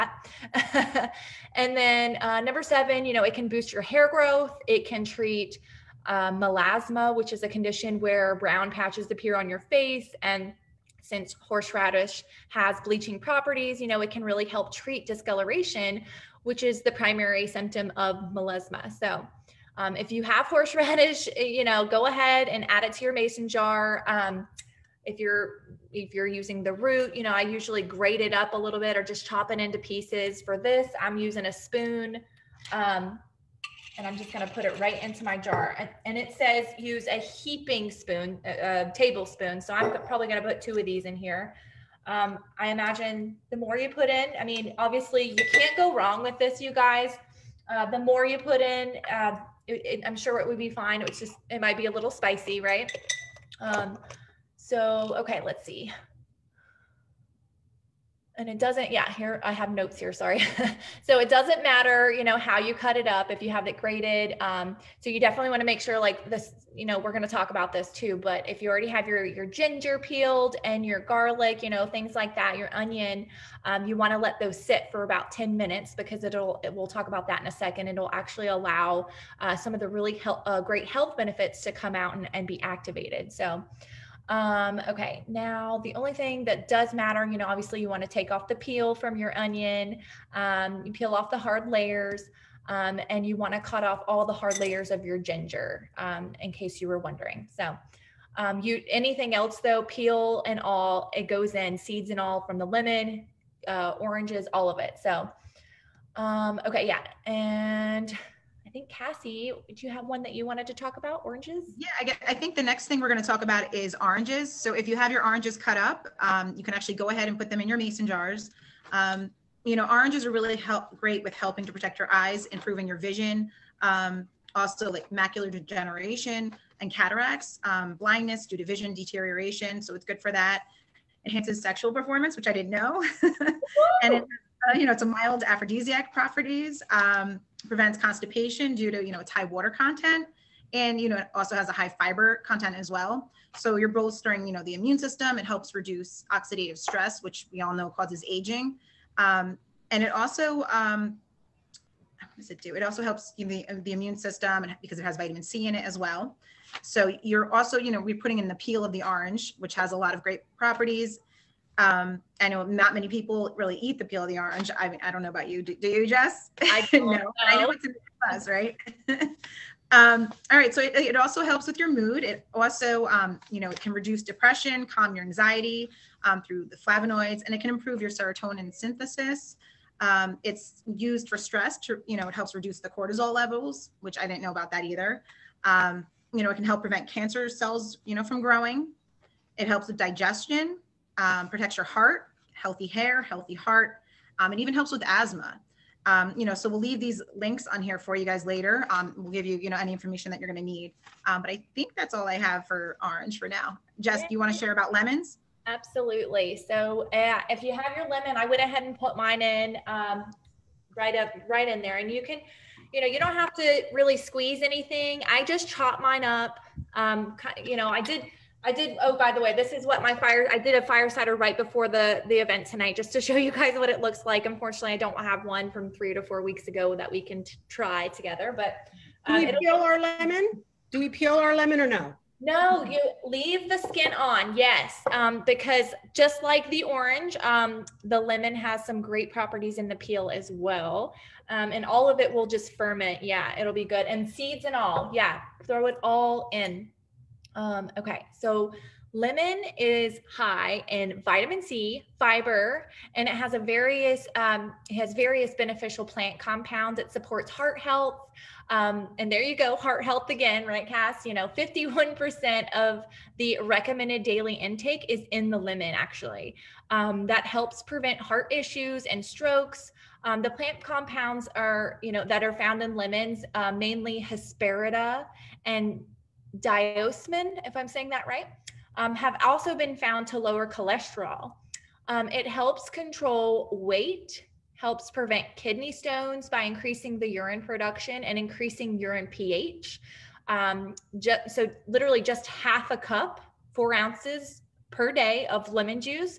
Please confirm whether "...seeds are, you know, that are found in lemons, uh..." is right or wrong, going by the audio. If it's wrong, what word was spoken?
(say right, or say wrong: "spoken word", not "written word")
wrong: "compounds", not "seeds".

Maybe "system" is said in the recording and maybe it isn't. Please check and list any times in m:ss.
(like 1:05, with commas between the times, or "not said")
2:24, 2:34.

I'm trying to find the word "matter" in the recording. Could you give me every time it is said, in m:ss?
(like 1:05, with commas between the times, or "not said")
1:01, 1:26.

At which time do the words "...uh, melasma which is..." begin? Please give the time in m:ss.
0:06.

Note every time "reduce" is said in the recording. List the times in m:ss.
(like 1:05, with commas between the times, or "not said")
2:25, 2:53, 3:02.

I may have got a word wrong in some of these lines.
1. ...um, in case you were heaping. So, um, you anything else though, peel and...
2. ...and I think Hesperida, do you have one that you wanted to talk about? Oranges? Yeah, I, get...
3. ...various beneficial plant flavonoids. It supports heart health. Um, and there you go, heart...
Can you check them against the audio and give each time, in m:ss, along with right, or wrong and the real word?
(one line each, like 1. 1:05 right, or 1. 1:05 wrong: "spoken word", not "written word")
1. 1:35 wrong: "wondering", not "heaping"
2. 1:47 wrong: "Cassie", not "Hesperida"
3. 4:15 wrong: "compounds", not "flavonoids".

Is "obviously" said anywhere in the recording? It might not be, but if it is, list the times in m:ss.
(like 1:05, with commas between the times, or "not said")
0:44, 1:27.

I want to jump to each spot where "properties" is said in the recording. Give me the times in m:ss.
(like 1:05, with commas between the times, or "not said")
0:13, 2:16, 2:40, 3:59.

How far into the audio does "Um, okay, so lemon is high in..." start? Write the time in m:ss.
4:07.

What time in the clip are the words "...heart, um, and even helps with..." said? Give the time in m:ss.
3:13.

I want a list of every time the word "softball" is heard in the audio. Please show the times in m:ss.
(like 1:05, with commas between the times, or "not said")
not said.